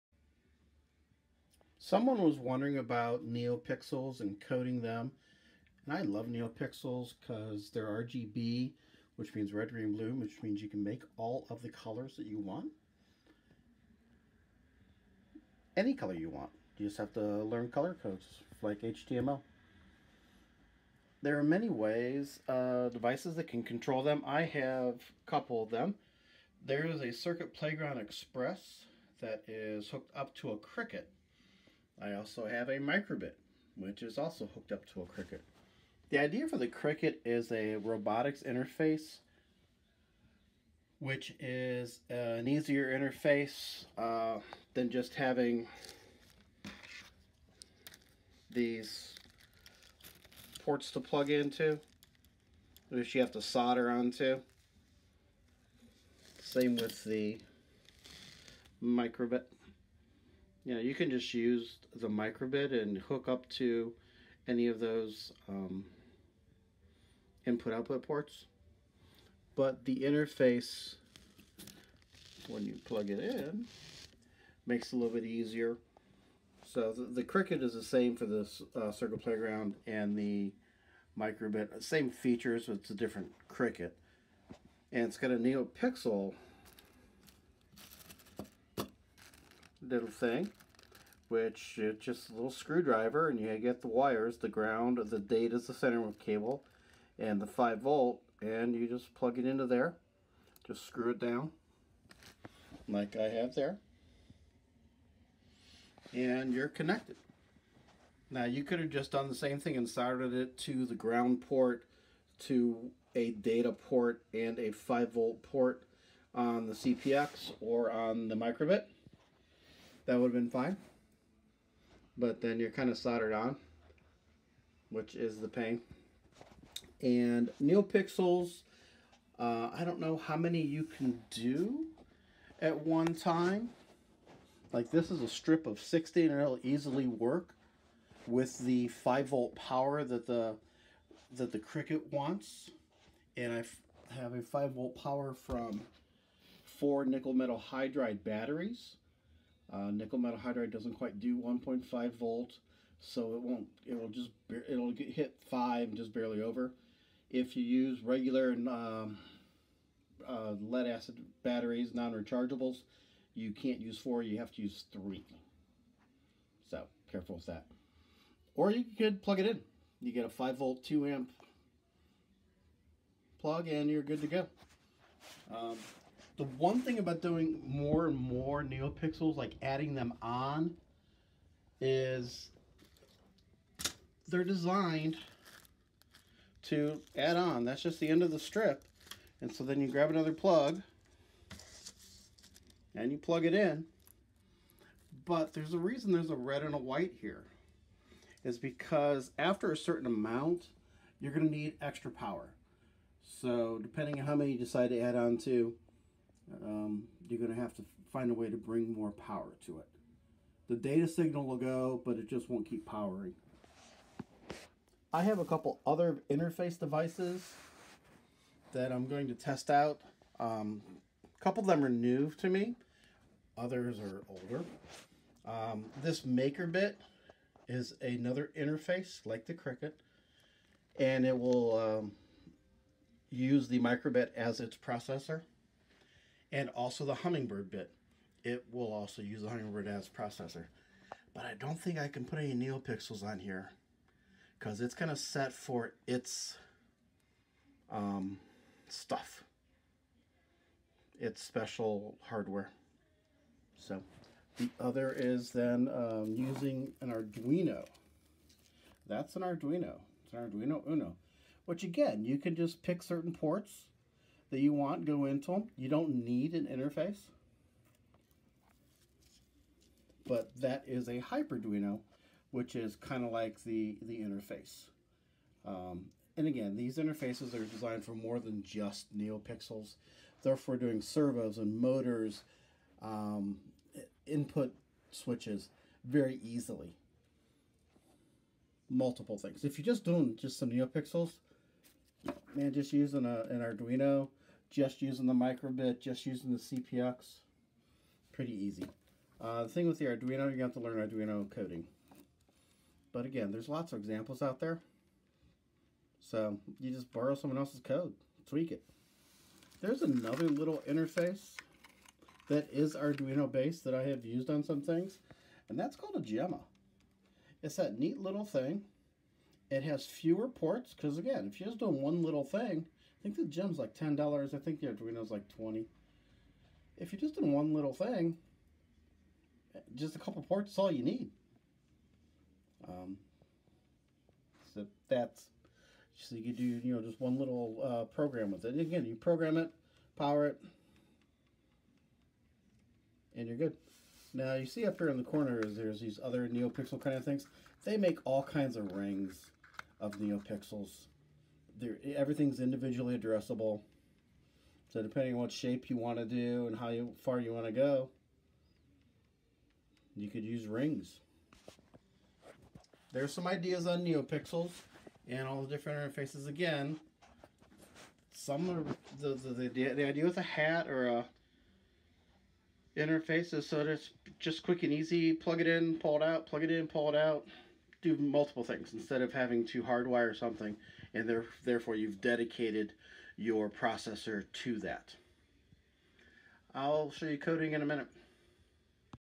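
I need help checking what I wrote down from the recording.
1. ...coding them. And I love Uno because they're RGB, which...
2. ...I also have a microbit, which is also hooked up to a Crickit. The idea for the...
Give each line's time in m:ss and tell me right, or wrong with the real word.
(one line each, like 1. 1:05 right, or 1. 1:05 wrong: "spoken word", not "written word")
1. 0:04 wrong: "NeoPixels", not "Uno"
2. 0:32 right.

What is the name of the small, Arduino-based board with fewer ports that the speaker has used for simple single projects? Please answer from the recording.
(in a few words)
Gemma.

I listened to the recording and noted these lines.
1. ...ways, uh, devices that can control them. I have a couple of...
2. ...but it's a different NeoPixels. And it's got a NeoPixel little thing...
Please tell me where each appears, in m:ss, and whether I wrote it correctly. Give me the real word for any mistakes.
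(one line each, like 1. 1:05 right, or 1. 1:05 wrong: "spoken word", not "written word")
1. 0:21 right
2. 1:22 wrong: "Crickit", not "NeoPixels".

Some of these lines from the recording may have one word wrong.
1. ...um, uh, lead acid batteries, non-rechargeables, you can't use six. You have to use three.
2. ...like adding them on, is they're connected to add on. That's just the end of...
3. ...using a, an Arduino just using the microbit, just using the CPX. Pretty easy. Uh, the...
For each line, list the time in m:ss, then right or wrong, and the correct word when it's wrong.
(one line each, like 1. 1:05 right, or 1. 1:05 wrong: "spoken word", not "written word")
1. 2:38 wrong: "four", not "six"
2. 2:59 wrong: "designed", not "connected"
3. 4:52 right.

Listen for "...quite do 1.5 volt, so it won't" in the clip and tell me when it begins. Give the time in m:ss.
2:30.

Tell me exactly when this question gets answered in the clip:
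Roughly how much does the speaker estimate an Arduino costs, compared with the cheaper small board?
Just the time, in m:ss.
5:25.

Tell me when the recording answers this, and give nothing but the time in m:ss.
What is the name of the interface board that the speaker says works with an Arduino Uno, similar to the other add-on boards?
4:31.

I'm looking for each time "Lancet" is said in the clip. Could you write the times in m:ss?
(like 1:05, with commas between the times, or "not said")
not said.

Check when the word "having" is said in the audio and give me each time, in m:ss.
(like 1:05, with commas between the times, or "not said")
0:45, 6:19.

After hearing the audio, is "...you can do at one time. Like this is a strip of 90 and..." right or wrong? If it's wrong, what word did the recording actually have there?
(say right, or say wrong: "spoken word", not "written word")
wrong: "60", not "90".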